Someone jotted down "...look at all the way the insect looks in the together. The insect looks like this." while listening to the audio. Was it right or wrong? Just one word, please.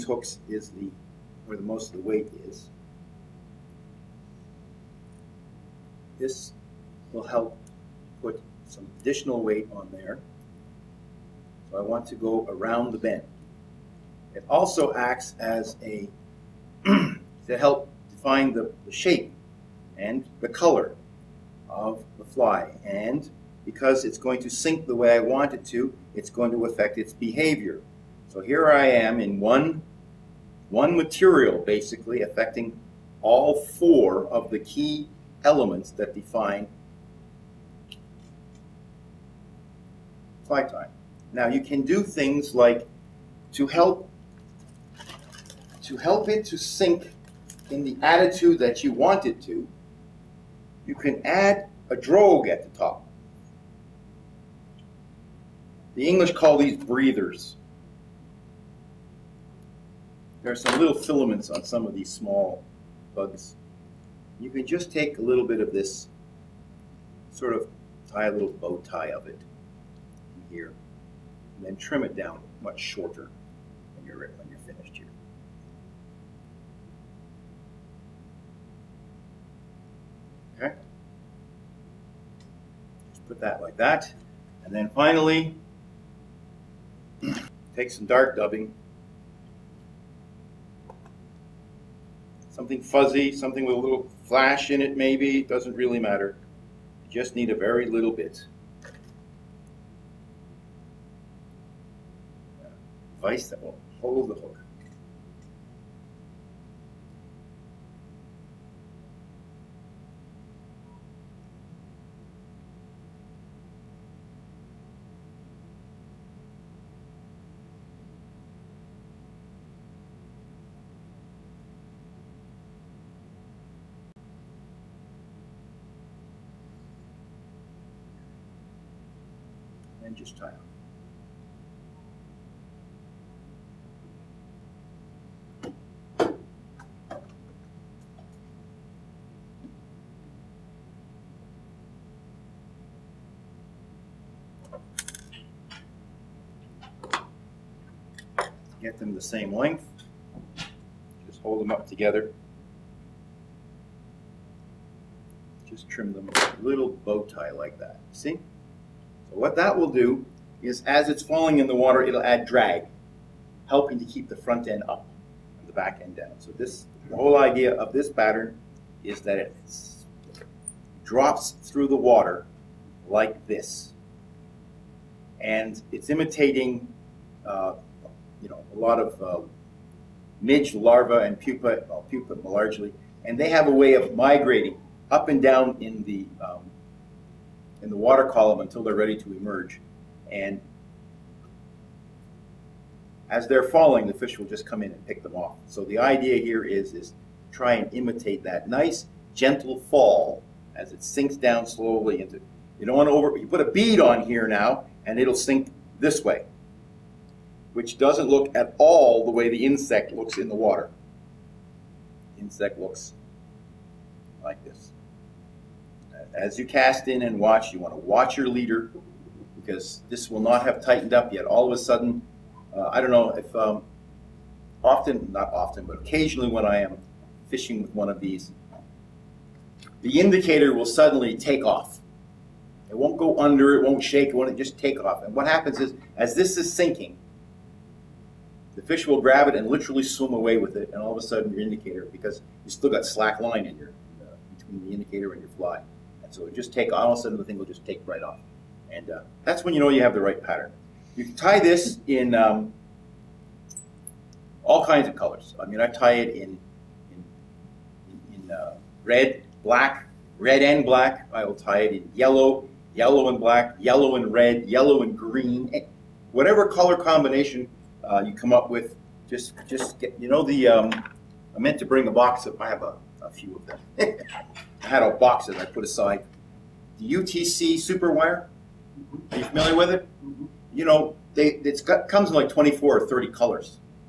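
wrong.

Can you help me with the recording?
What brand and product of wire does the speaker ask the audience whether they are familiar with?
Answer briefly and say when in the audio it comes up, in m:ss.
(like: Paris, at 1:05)
UTC super wire, at 4:36.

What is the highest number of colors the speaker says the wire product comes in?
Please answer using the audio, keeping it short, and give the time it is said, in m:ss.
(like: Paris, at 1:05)
30, at 4:43.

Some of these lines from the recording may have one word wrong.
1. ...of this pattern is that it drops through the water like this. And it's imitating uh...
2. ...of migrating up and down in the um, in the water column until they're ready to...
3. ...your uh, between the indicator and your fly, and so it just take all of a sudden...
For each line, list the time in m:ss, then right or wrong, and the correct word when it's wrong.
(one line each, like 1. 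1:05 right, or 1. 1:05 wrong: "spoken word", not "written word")
1. 2:47 right
2. 3:03 right
3. 4:03 right.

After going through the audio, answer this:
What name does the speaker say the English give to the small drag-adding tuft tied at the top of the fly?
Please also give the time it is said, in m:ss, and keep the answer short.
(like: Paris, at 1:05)
Breathers, at 0:56.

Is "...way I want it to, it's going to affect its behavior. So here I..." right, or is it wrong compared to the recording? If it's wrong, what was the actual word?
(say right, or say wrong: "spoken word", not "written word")
right.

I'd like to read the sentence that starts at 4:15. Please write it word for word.
I mean, I tie it in in, in uh, red, black, red and black.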